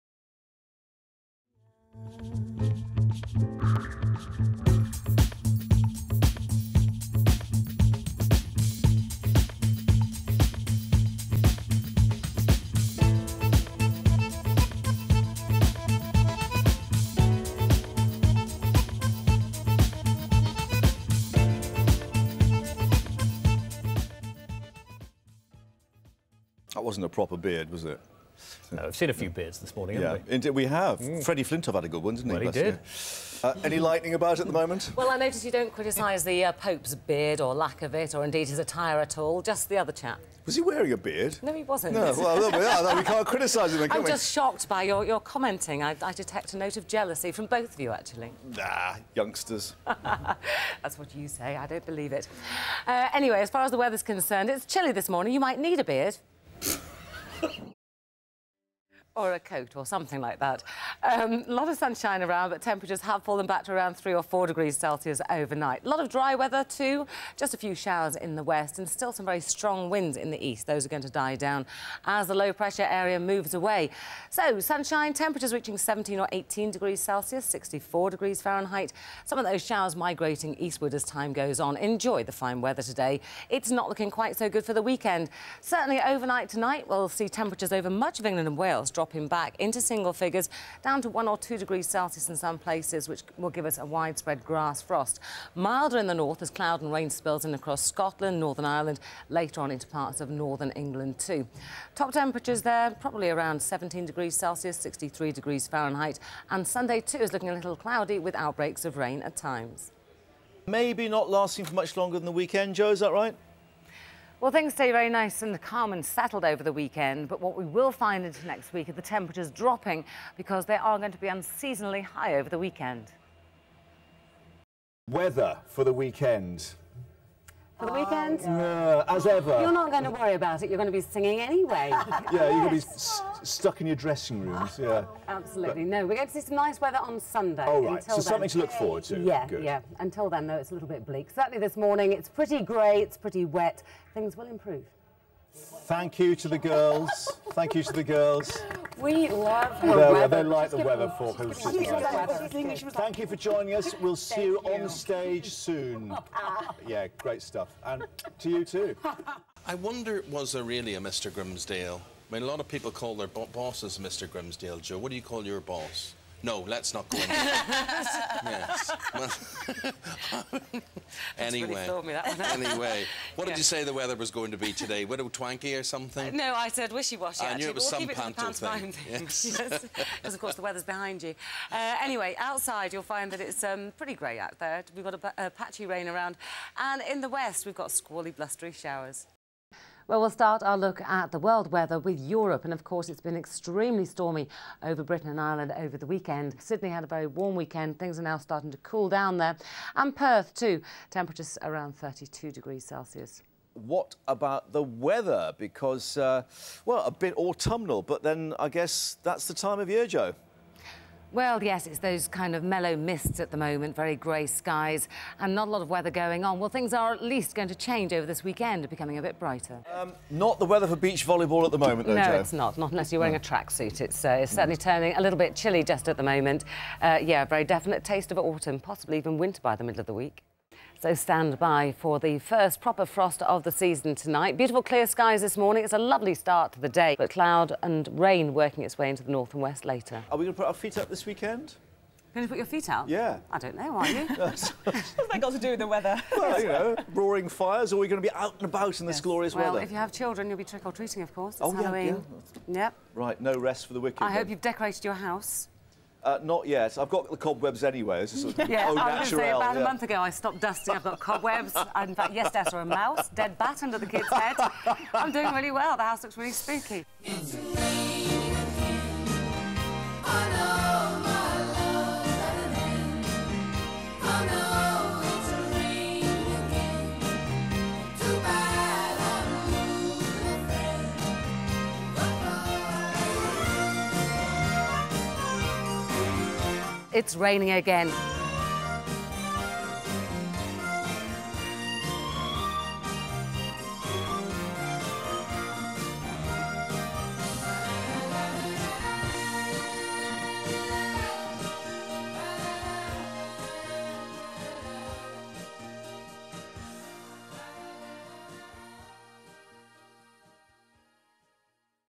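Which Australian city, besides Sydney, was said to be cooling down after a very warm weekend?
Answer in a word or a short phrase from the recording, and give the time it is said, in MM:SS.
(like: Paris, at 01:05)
Perth, at 03:20.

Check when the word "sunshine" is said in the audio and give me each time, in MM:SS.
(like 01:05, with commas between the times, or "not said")
01:01, 01:14.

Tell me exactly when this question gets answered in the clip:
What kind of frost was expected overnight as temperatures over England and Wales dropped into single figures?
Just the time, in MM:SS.
01:34.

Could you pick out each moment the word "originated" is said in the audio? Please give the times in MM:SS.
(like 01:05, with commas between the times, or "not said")
not said.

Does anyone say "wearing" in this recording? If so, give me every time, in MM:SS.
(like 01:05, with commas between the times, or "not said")
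00:40, 03:43.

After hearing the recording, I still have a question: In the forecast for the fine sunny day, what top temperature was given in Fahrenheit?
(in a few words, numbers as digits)
64 degrees Fahrenheit.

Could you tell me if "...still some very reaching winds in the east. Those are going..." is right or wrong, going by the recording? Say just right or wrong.
wrong.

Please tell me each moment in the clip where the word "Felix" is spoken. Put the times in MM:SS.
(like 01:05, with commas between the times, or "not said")
not said.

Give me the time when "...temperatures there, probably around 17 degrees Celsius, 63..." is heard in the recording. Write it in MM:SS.
01:42.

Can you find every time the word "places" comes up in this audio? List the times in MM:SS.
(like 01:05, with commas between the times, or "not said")
01:32.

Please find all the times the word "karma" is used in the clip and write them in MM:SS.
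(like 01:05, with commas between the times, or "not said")
not said.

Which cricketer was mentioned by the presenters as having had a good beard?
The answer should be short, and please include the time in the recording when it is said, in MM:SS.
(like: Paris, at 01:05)
Freddie Flintoff, at 00:31.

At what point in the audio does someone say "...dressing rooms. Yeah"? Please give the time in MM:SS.
02:13.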